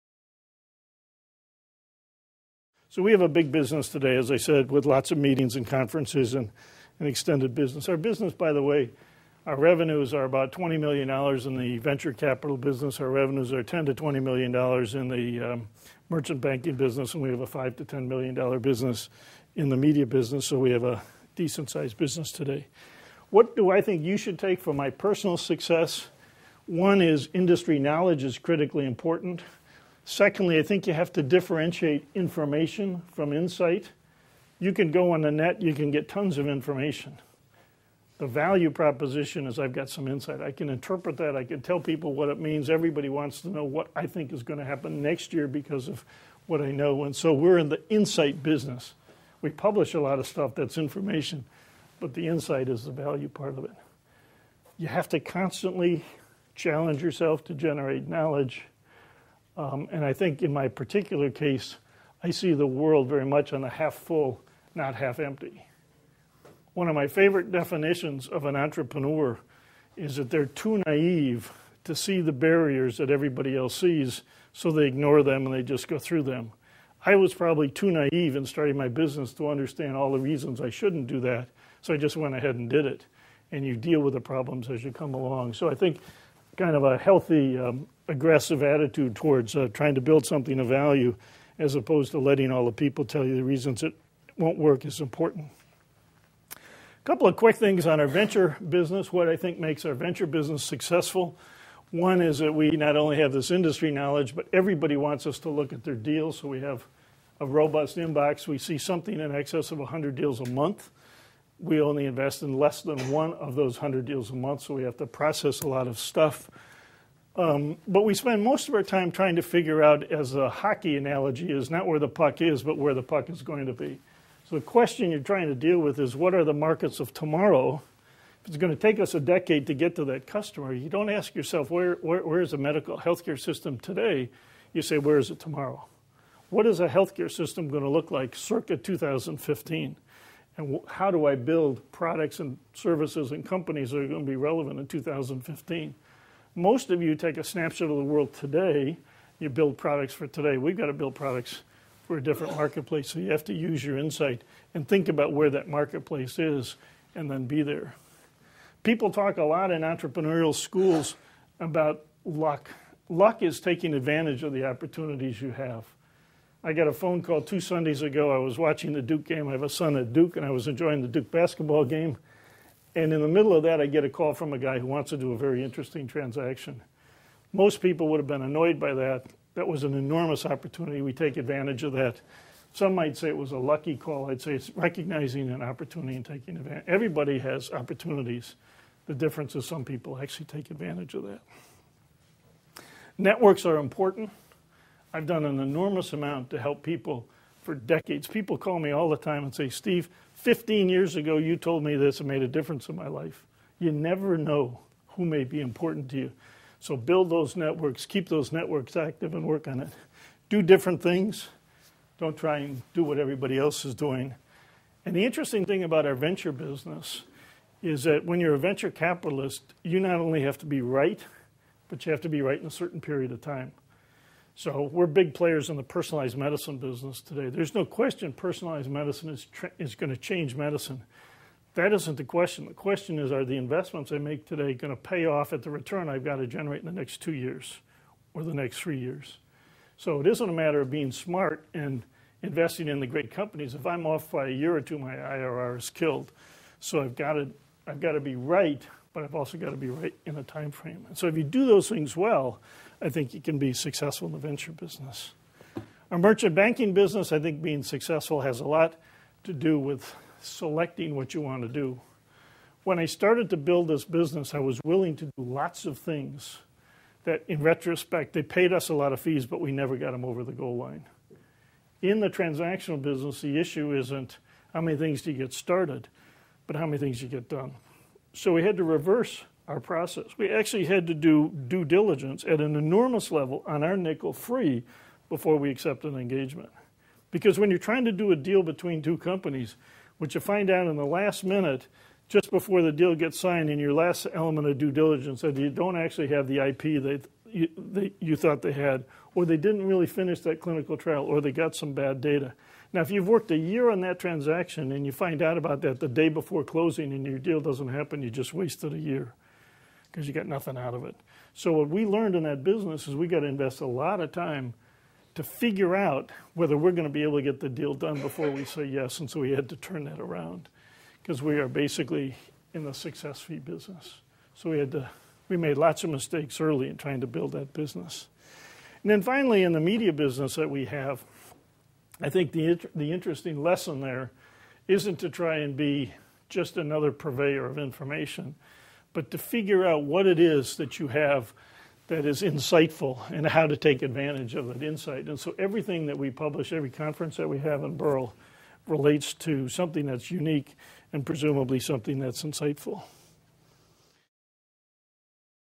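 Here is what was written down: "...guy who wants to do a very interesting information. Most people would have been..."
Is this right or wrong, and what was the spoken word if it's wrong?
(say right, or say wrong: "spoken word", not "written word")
wrong: "transaction", not "information".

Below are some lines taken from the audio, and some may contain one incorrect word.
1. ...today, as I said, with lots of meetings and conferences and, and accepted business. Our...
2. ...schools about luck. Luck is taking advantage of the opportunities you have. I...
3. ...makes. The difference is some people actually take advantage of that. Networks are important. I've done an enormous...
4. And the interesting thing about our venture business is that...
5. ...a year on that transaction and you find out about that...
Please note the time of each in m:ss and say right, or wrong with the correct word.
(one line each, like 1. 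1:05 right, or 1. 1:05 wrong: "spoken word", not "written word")
1. 0:03 wrong: "extended", not "accepted"
2. 2:40 right
3. 3:07 wrong: "opportunities", not "makes"
4. 3:35 right
5. 5:03 right.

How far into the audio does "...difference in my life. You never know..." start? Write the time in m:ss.
3:22.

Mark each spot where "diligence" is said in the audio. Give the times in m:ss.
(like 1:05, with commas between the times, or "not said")
4:41, 4:54.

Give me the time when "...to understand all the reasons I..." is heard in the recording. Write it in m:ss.
1:19.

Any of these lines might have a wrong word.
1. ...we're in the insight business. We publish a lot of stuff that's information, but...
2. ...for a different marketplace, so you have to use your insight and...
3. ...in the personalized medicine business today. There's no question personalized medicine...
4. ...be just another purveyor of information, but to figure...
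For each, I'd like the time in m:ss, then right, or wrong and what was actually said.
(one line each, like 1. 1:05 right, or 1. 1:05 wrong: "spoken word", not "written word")
1. 0:47 right
2. 2:32 right
3. 3:45 right
4. 5:35 right.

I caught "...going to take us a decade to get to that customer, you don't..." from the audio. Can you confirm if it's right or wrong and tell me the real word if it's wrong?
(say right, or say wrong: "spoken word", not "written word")
right.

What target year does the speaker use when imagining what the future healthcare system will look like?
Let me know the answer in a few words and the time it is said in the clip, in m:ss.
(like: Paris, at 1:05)
2015, at 2:18.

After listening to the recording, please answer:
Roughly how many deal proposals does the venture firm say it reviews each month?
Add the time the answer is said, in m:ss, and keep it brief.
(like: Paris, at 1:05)
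more than 100, at 1:49.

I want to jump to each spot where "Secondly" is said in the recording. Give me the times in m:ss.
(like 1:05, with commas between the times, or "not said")
0:30.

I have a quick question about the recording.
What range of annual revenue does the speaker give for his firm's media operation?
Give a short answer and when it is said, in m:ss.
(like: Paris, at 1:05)
$5 to $10 million, at 0:17.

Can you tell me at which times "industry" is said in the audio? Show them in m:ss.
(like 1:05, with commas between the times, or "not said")
0:27, 1:43.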